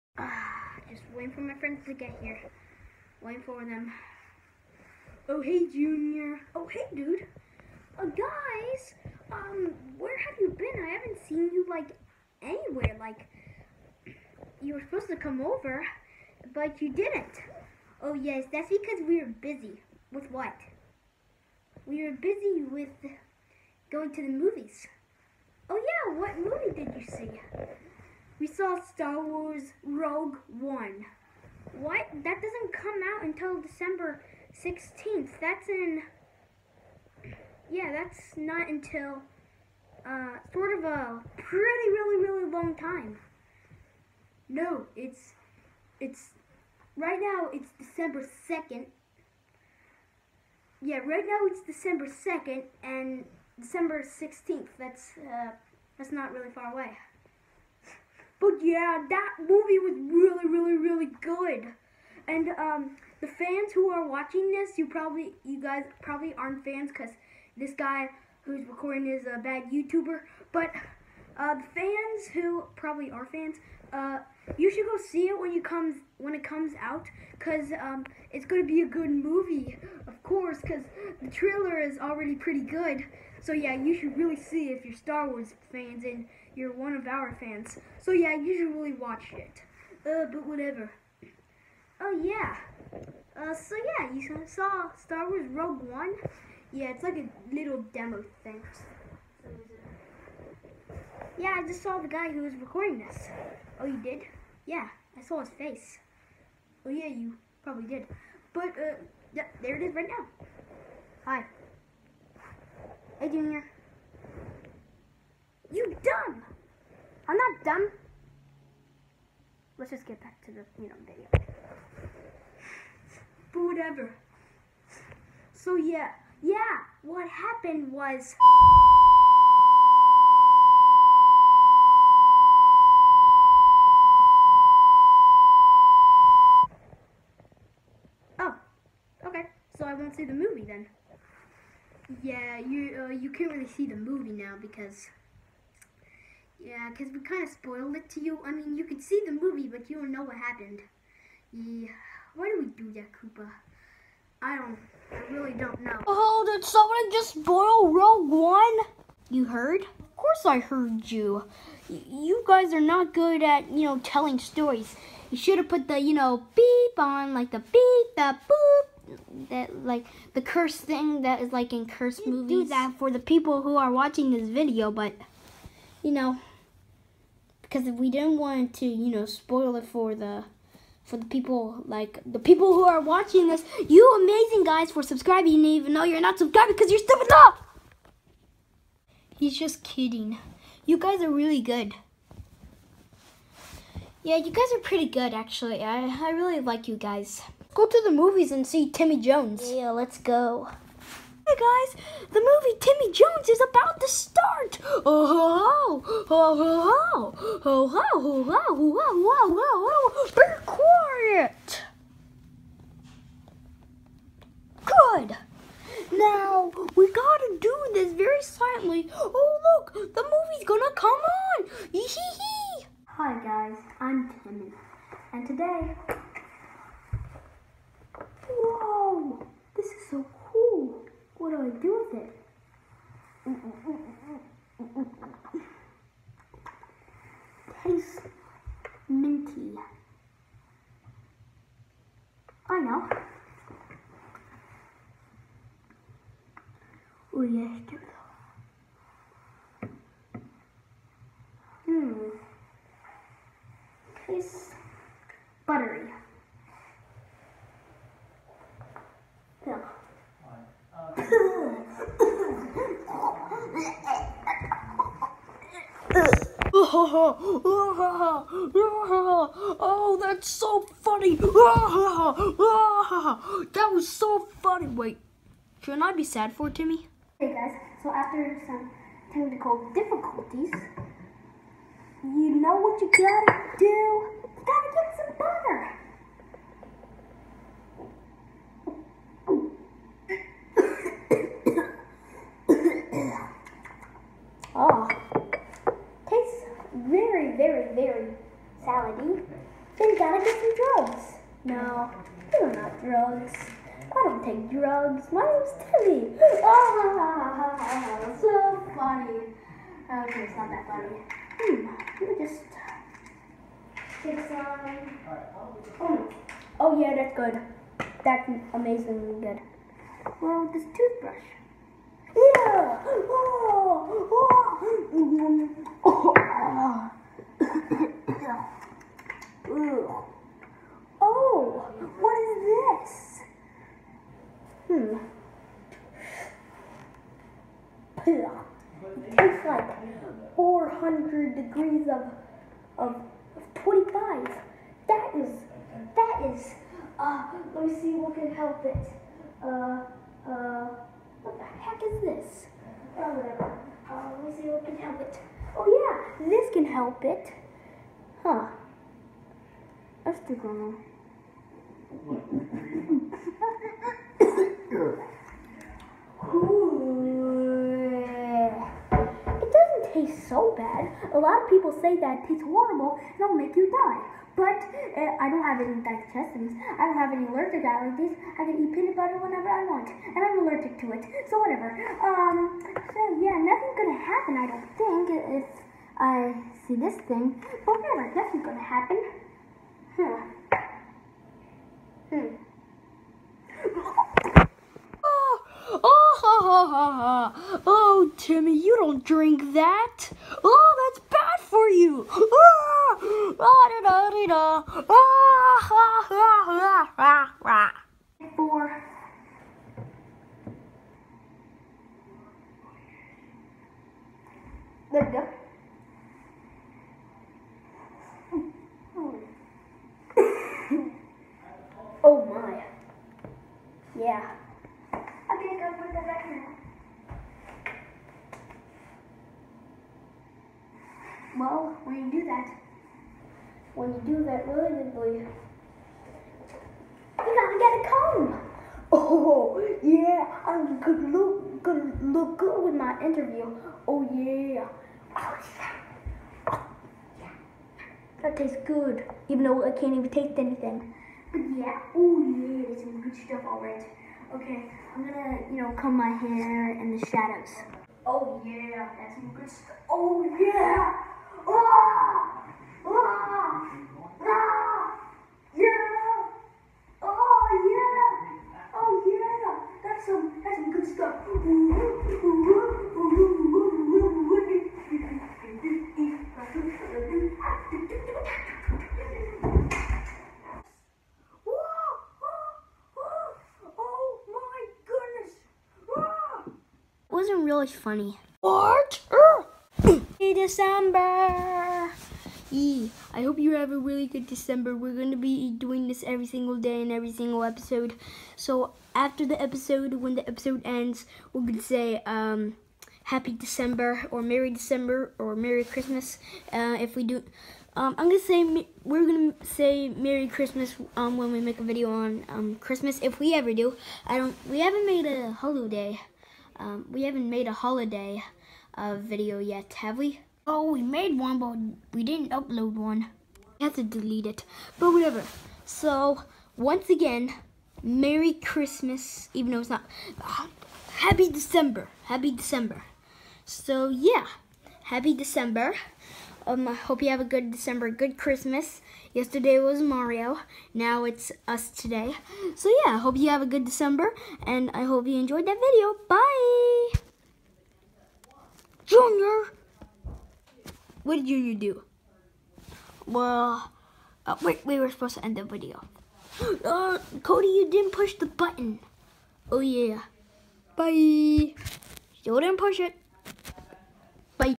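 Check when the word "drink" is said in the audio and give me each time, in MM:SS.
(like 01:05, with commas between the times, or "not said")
06:39.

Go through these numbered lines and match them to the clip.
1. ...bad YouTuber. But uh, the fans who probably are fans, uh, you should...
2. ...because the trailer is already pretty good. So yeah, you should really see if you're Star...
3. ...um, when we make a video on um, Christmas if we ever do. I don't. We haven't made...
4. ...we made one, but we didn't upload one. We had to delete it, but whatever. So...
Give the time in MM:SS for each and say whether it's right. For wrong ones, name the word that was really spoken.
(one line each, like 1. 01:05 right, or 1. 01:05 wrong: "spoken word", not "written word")
1. 01:09 right
2. 01:20 right
3. 08:31 right
4. 08:40 right.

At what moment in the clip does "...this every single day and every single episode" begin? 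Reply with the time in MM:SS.
08:16.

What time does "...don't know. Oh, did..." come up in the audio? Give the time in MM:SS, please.
02:35.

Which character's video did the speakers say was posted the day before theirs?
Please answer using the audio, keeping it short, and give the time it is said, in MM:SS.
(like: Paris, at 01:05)
Mario, at 09:00.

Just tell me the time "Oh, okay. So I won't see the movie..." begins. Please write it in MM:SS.
02:18.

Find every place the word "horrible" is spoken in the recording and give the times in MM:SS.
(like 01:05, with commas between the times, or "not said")
06:12.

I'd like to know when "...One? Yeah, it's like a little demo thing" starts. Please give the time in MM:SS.
01:35.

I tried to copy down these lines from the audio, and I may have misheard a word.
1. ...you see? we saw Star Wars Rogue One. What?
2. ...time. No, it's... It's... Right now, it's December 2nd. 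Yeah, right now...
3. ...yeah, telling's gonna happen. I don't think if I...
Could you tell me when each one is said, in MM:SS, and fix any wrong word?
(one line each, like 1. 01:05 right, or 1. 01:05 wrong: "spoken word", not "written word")
1. 00:26 right
2. 00:42 right
3. 06:23 wrong: "nothing", not "telling".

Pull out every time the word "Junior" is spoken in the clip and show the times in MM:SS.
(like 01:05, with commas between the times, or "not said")
00:05, 01:53, 09:09.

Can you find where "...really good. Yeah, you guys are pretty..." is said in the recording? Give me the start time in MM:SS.
03:11.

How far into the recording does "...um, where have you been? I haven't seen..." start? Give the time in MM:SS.
00:09.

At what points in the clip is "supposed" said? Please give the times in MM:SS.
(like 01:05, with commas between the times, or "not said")
00:14, 09:15.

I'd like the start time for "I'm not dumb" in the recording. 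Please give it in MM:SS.
01:57.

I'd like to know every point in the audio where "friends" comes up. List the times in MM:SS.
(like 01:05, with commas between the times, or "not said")
00:01.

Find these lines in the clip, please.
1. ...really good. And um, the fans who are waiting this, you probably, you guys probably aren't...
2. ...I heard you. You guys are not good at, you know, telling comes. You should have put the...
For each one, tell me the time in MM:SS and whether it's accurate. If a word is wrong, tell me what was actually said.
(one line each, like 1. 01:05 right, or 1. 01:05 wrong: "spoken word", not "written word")
1. 01:00 wrong: "watching", not "waiting"
2. 02:40 wrong: "stories", not "comes".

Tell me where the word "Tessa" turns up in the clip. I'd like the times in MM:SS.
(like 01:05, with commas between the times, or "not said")
not said.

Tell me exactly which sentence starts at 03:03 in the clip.
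You amazing guys for subscribing even though you're not subscribed because you're stupid enough.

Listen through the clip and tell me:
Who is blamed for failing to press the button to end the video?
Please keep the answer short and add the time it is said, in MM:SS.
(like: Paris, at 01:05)
Cody, at 09:17.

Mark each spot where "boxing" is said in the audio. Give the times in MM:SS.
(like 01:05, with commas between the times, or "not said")
not said.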